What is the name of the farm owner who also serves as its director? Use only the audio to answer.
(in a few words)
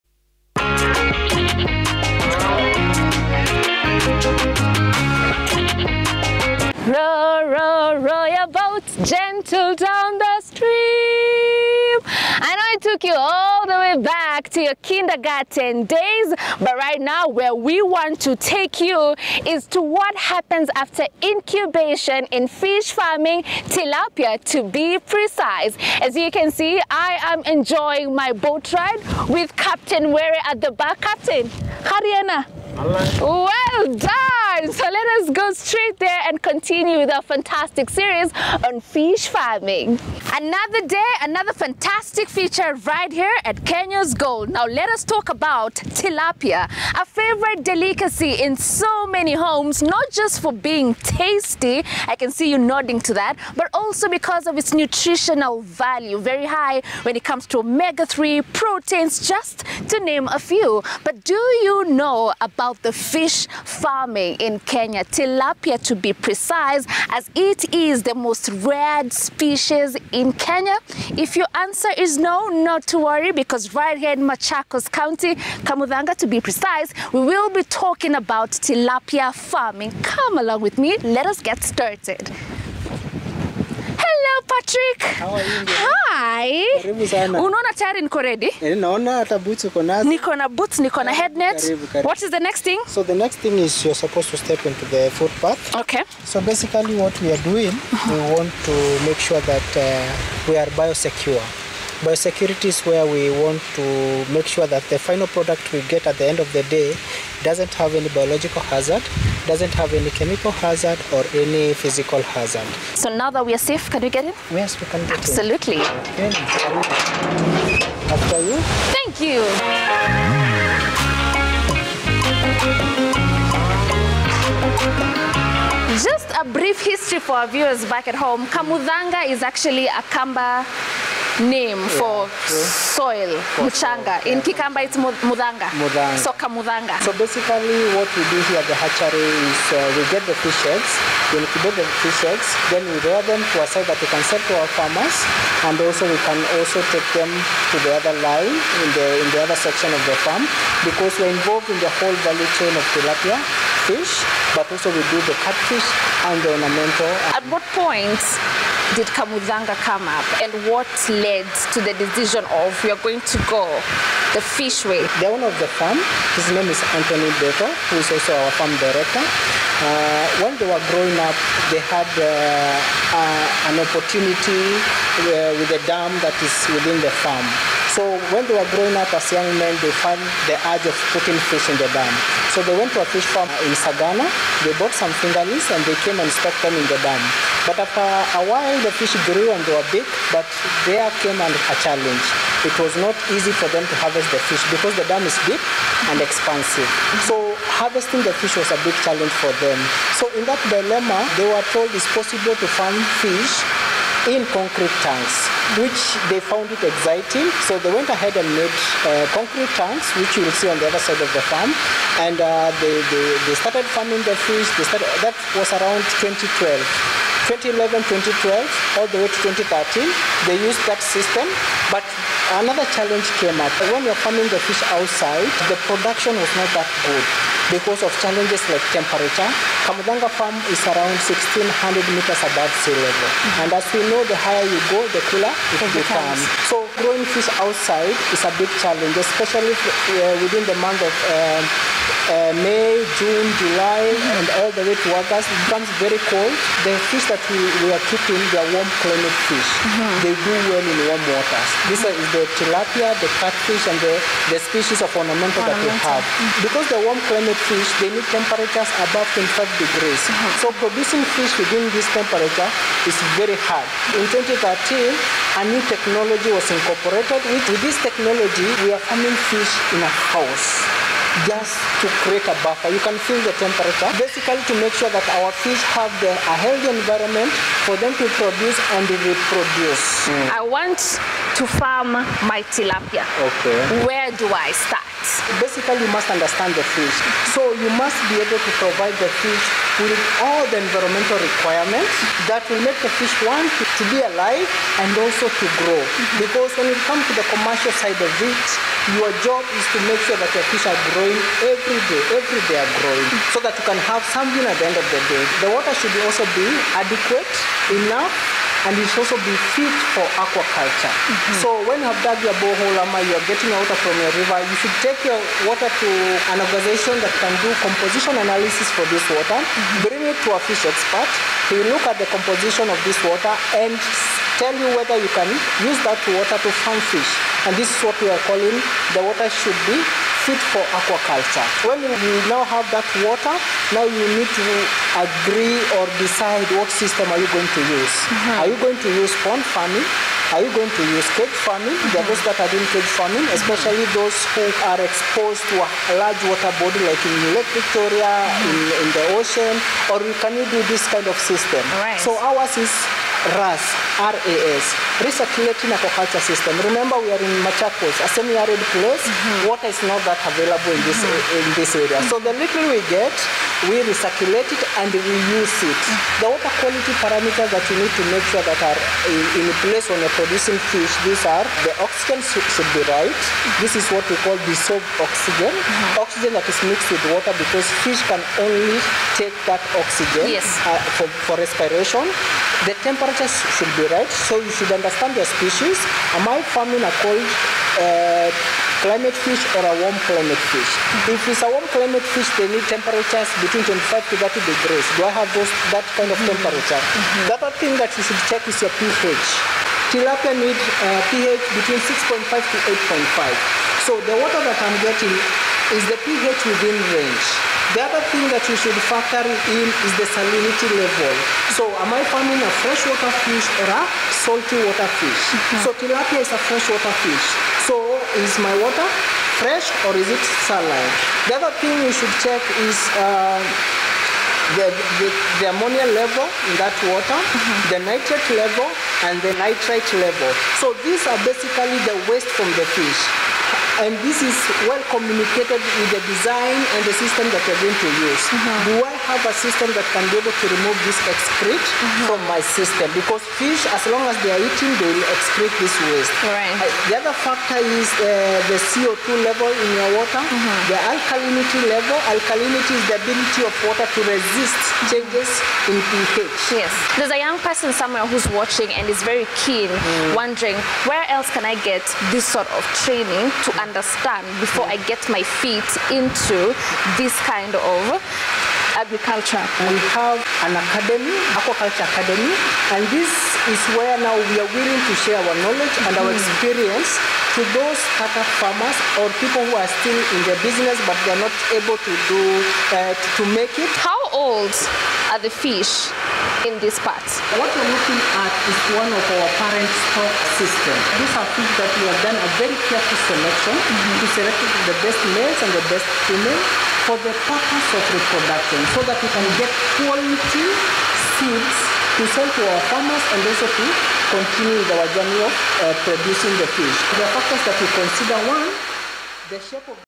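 Anthony Beto.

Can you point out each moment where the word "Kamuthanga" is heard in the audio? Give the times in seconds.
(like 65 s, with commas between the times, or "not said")
75 s, 128 s, 159 s, 229 s.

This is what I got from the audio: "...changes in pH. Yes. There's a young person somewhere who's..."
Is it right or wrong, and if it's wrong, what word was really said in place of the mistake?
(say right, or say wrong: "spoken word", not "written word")
right.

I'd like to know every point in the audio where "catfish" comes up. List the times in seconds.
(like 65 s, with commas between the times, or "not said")
155 s, 253 s.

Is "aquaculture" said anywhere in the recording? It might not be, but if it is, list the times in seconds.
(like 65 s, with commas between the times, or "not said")
310 s, 330 s, 355 s, 471 s.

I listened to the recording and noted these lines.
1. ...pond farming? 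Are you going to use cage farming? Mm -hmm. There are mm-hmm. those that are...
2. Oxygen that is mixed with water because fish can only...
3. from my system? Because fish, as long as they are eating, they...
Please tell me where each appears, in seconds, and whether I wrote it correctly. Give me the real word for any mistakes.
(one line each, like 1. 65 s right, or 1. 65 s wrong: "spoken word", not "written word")
1. 339 s right
2. 376 s right
3. 442 s right.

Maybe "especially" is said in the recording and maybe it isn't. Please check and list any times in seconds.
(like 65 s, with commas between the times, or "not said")
239 s, 343 s.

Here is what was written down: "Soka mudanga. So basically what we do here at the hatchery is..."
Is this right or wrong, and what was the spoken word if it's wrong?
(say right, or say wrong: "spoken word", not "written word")
right.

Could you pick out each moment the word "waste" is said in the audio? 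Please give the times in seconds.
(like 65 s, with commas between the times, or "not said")
432 s, 446 s.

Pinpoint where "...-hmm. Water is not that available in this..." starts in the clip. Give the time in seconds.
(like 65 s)
359 s.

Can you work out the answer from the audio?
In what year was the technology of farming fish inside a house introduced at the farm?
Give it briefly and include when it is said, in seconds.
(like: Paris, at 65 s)
2013, at 264 s.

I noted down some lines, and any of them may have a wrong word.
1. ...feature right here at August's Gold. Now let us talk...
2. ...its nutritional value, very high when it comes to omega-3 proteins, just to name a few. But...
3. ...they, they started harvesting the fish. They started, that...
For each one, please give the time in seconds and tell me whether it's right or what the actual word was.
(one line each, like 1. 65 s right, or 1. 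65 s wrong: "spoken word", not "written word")
1. 42 s wrong: "Kenya", not "August"
2. 54 s right
3. 213 s wrong: "farming", not "harvesting".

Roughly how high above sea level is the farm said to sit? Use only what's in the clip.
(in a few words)
1600 meters.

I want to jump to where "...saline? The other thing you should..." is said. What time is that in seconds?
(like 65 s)
420 s.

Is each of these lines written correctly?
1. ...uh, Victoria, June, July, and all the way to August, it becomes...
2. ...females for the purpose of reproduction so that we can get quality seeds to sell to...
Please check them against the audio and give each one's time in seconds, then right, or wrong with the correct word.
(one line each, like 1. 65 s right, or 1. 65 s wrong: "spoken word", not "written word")
1. 242 s wrong: "May", not "Victoria"
2. 496 s right.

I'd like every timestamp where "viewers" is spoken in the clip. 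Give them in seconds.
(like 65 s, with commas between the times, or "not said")
127 s.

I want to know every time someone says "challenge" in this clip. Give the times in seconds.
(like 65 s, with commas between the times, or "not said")
191 s, 199 s, 222 s, 228 s, 238 s.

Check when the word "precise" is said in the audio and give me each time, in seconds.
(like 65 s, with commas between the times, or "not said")
24 s, 66 s, 76 s.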